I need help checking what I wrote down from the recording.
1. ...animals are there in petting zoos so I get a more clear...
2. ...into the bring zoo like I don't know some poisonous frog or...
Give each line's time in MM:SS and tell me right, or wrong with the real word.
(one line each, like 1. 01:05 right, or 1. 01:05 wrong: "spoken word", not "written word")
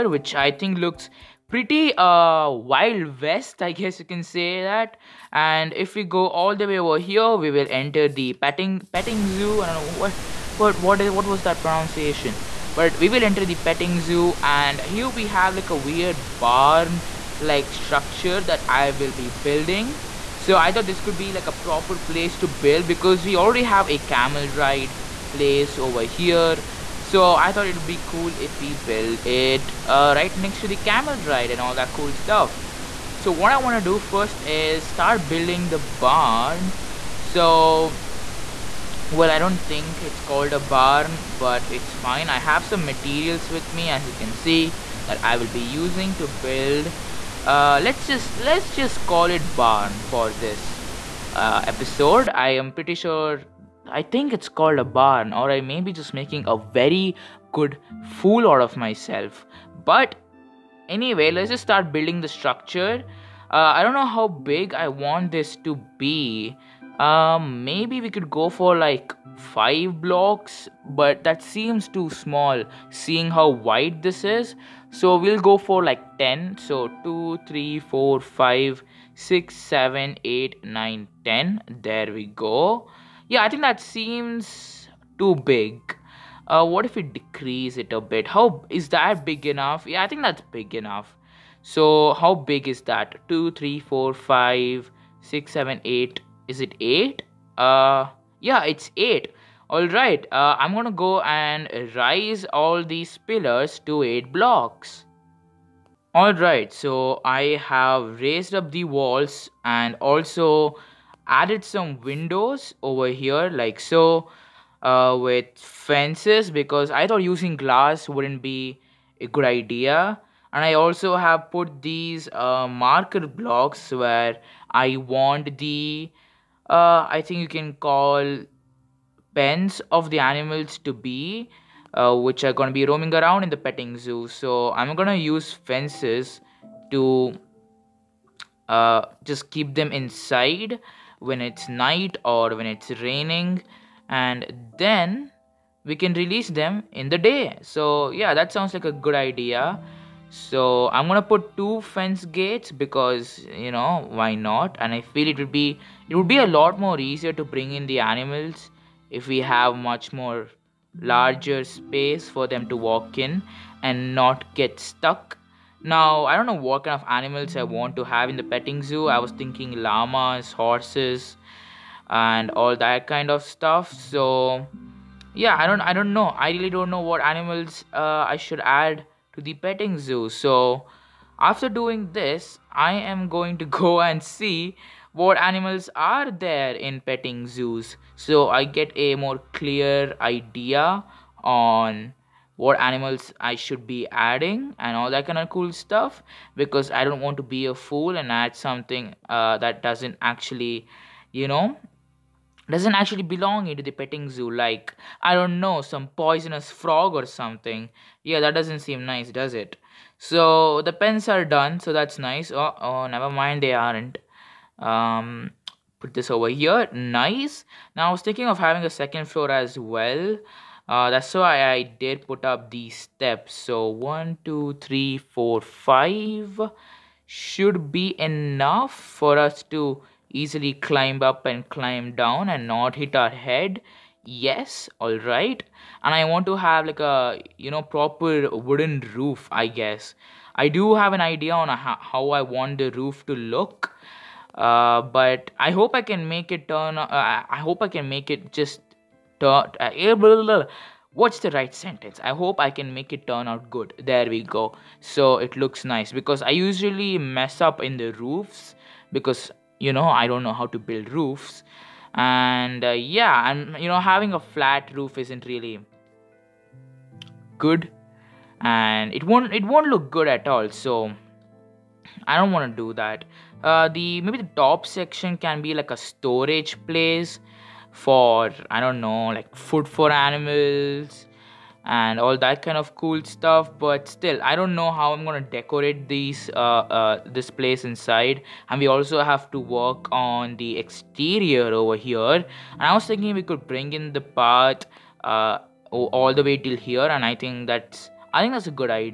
1. 03:05 right
2. 03:23 wrong: "petting", not "bring".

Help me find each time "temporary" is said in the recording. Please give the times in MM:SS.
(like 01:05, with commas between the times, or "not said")
not said.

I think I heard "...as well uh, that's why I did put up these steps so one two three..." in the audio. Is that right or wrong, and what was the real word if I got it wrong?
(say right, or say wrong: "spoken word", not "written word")
right.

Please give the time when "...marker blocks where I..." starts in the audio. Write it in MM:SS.
02:02.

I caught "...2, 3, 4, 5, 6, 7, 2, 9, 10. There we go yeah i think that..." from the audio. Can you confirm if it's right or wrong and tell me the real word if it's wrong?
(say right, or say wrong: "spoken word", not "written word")
wrong: "8", not "2".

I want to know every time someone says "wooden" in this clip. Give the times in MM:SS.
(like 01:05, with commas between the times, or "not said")
03:58.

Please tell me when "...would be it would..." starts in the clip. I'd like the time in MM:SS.
02:35.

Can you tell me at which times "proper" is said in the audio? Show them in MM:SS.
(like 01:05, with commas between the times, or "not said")
00:21, 03:57.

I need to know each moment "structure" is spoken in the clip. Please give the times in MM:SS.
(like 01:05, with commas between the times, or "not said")
00:17, 01:02.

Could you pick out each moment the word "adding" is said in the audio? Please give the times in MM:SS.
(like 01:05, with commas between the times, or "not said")
03:14.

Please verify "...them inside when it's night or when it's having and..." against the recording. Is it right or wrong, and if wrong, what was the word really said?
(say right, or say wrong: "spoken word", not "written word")
wrong: "raining", not "having".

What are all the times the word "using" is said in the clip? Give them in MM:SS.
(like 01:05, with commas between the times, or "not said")
00:45, 01:57.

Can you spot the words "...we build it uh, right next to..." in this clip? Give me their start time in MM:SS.
00:28.